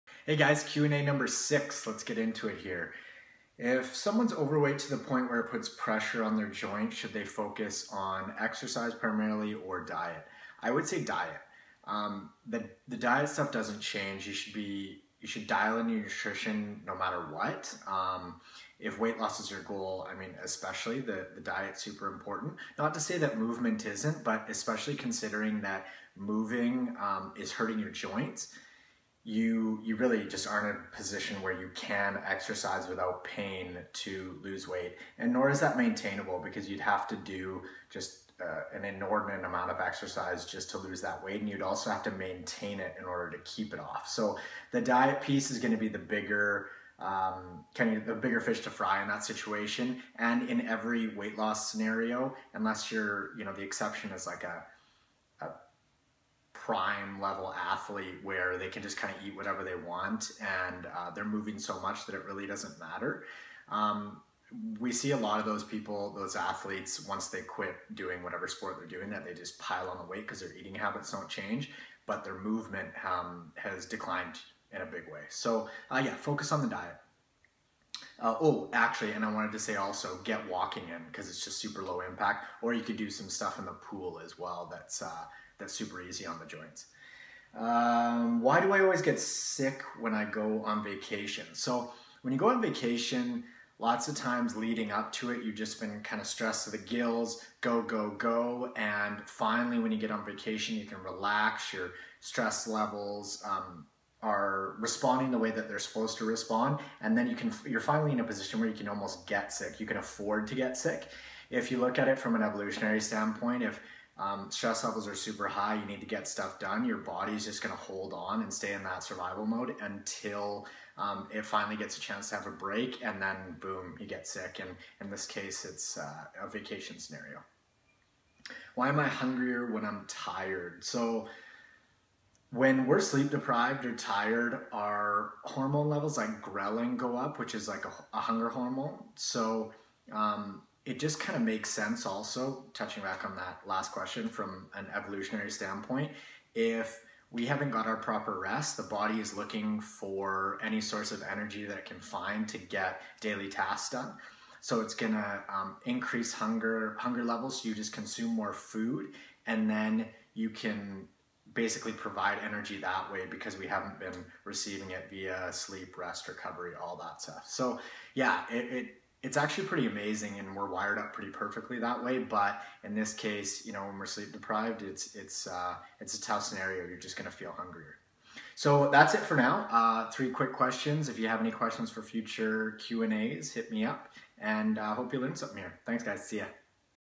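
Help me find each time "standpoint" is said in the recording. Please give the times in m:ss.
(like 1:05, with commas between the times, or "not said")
1:53, 2:25.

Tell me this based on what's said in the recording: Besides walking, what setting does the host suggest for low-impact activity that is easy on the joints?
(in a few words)
the pool.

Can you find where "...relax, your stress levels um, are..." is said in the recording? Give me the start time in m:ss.
1:41.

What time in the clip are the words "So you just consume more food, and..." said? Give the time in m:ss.
2:37.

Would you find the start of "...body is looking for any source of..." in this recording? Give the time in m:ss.
2:28.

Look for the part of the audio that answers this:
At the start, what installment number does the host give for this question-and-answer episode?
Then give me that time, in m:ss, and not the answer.
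0:01.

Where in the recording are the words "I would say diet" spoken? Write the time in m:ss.
0:10.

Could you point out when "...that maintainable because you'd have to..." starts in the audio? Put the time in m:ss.
0:35.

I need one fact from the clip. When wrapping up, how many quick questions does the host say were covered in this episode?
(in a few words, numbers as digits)
3.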